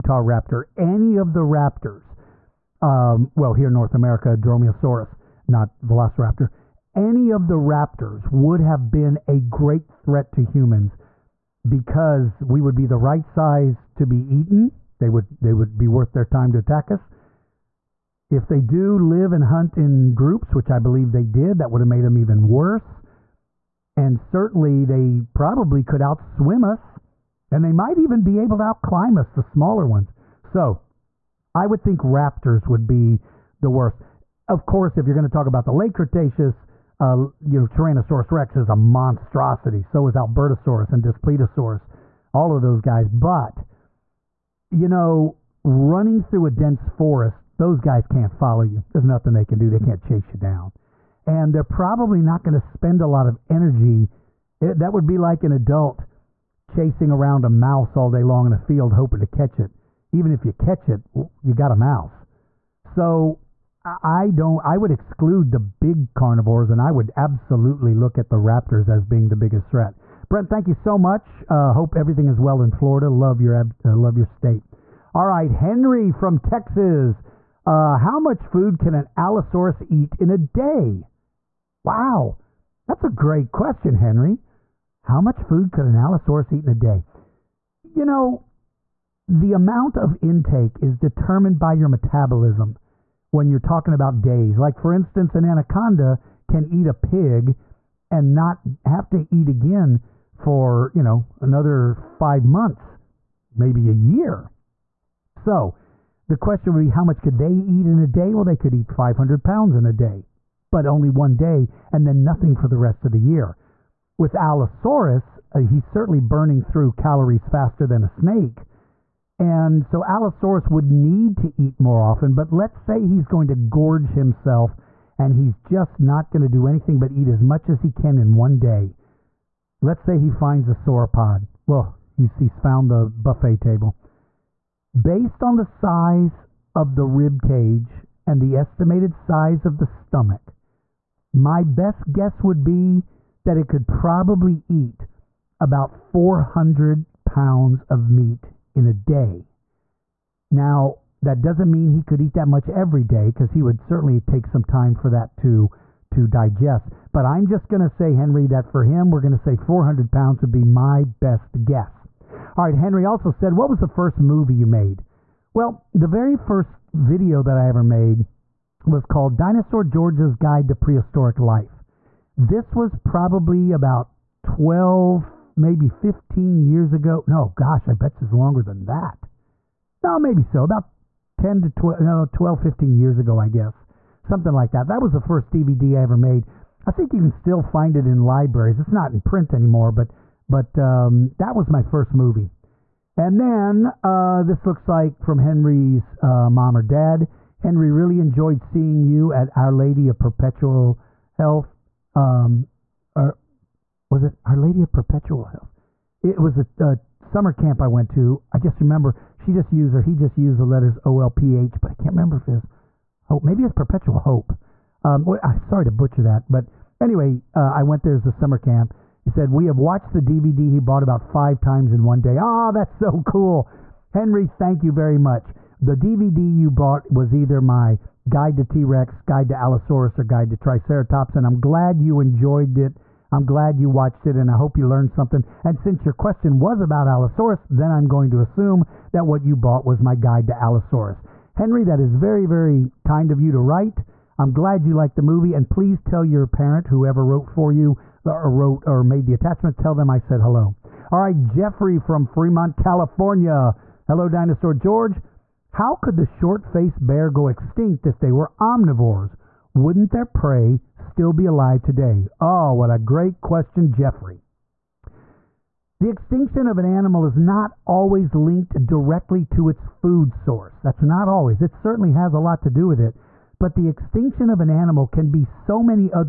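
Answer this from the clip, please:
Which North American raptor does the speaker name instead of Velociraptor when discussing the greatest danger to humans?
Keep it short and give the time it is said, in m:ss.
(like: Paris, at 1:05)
Dromaeosaurus, at 0:04.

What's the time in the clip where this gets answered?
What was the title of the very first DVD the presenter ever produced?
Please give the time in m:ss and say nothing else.
2:49.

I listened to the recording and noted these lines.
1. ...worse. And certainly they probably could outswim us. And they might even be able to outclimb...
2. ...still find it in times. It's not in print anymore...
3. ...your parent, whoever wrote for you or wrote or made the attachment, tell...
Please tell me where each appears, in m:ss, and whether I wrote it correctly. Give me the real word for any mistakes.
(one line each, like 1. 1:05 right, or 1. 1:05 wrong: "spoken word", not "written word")
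1. 0:22 right
2. 3:07 wrong: "libraries", not "times"
3. 4:06 right.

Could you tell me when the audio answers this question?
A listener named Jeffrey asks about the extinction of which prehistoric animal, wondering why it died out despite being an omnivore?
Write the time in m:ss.
4:16.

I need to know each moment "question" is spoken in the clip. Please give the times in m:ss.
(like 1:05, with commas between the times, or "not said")
1:23, 1:46, 3:56, 4:23.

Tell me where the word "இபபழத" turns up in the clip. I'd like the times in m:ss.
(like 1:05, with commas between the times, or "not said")
not said.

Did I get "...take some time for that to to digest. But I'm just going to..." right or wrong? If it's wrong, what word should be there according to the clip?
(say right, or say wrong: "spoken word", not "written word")
right.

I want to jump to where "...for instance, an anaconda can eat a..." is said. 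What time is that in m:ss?
1:34.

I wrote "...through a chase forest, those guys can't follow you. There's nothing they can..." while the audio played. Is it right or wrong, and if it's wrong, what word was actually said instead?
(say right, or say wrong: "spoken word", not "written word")
wrong: "dense", not "chase".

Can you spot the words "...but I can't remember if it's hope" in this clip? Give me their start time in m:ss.
3:31.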